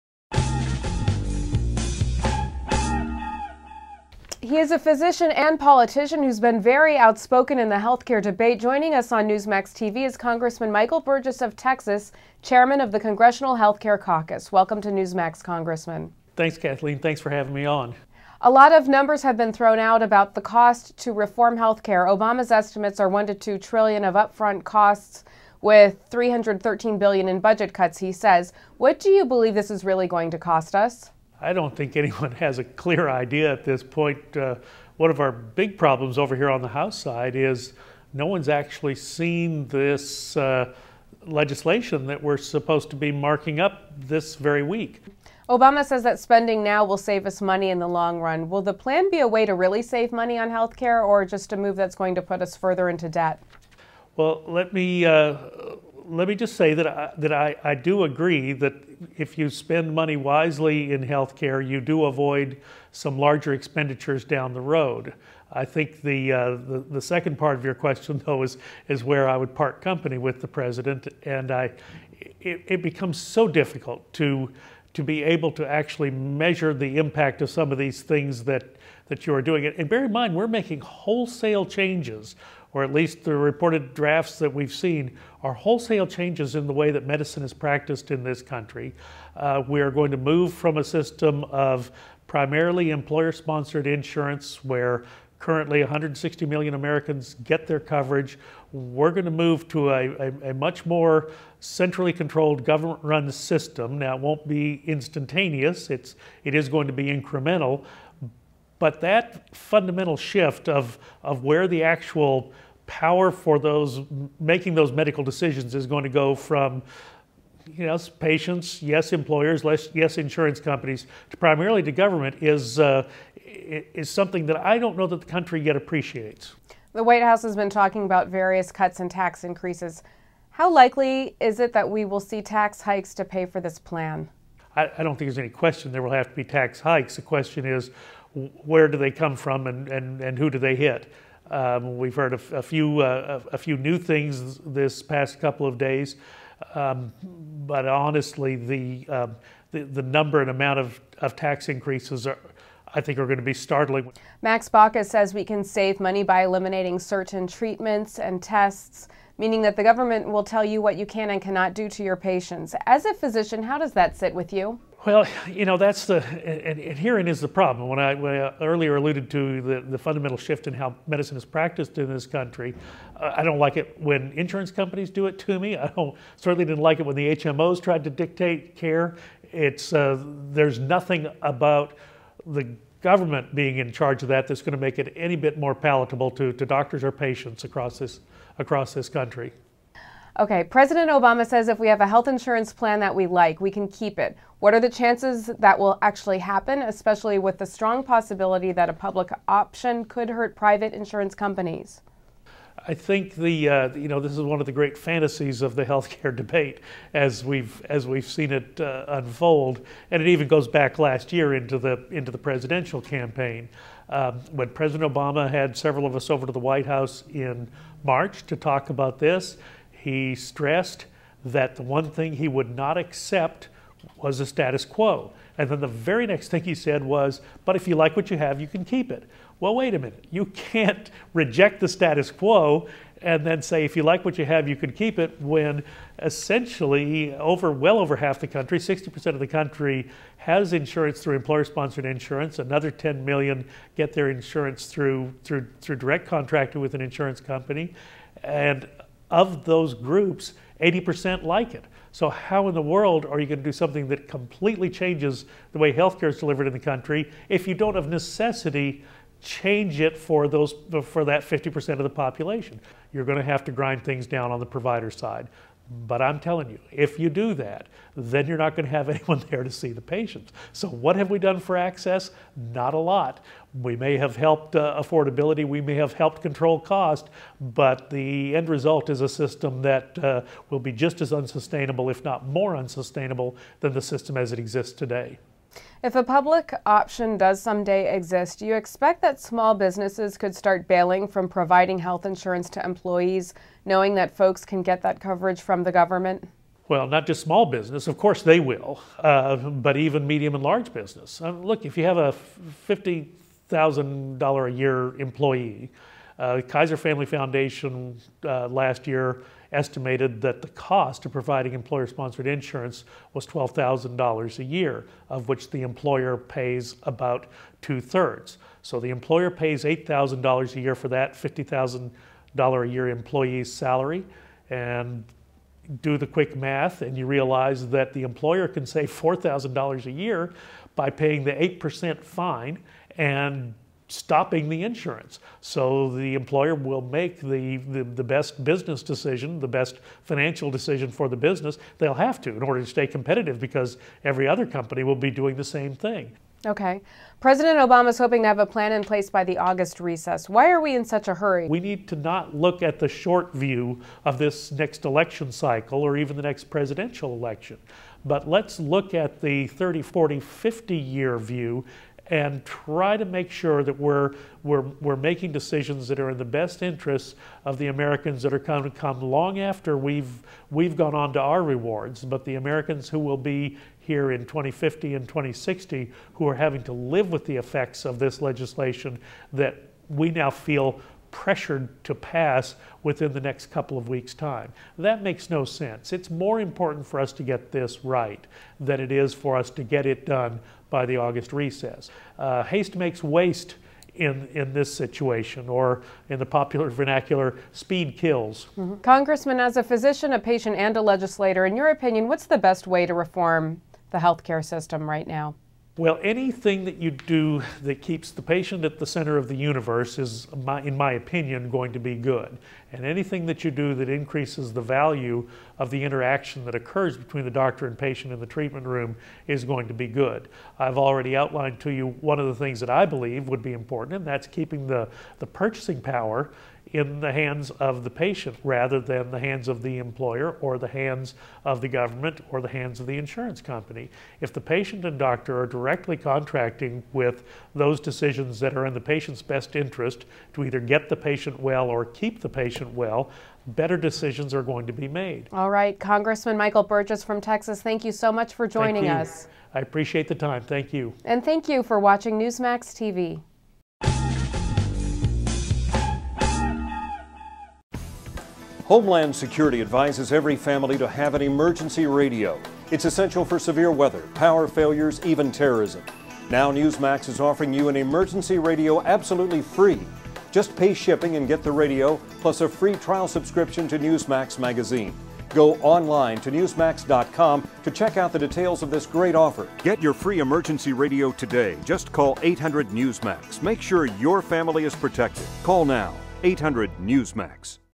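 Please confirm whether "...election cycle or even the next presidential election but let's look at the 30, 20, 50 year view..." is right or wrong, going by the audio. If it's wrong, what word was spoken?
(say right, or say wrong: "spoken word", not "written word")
wrong: "40", not "20".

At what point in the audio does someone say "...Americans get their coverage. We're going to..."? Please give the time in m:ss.
1:36.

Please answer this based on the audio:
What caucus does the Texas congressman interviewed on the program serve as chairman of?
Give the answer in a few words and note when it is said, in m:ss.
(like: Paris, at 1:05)
Congressional Healthcare Caucus, at 0:12.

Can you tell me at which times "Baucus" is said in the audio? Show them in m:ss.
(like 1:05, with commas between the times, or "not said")
2:34.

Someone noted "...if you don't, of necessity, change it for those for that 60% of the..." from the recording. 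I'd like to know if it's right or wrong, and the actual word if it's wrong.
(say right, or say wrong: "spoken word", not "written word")
wrong: "50", not "60".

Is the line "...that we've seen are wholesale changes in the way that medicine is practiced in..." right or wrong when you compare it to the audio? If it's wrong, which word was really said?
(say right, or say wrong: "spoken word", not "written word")
right.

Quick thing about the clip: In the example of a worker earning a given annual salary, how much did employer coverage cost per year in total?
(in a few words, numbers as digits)
$12,000.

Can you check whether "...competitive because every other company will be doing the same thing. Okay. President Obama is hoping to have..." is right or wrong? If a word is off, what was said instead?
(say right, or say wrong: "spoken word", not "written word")
right.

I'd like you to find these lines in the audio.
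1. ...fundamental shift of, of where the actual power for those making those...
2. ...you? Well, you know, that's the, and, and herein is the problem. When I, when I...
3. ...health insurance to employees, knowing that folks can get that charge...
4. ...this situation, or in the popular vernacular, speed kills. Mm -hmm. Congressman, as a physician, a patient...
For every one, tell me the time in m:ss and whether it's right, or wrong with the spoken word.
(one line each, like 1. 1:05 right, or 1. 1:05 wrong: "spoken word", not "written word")
1. 1:49 right
2. 2:44 right
3. 4:51 wrong: "coverage", not "charge"
4. 6:34 right.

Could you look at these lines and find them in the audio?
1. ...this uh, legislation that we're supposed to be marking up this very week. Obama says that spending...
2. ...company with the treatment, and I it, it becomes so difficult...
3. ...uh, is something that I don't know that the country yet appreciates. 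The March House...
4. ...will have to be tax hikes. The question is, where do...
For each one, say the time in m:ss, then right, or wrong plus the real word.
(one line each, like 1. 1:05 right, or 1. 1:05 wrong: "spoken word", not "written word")
1. 0:39 right
2. 1:09 wrong: "president", not "treatment"
3. 2:02 wrong: "White", not "March"
4. 2:16 right.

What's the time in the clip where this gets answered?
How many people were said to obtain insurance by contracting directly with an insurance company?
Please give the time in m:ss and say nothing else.
4:02.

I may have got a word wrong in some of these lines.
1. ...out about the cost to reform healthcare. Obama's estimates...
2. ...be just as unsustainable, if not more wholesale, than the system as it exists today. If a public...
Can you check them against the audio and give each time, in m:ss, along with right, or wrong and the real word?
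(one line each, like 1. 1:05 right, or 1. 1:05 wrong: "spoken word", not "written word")
1. 0:19 right
2. 4:40 wrong: "unsustainable", not "wholesale".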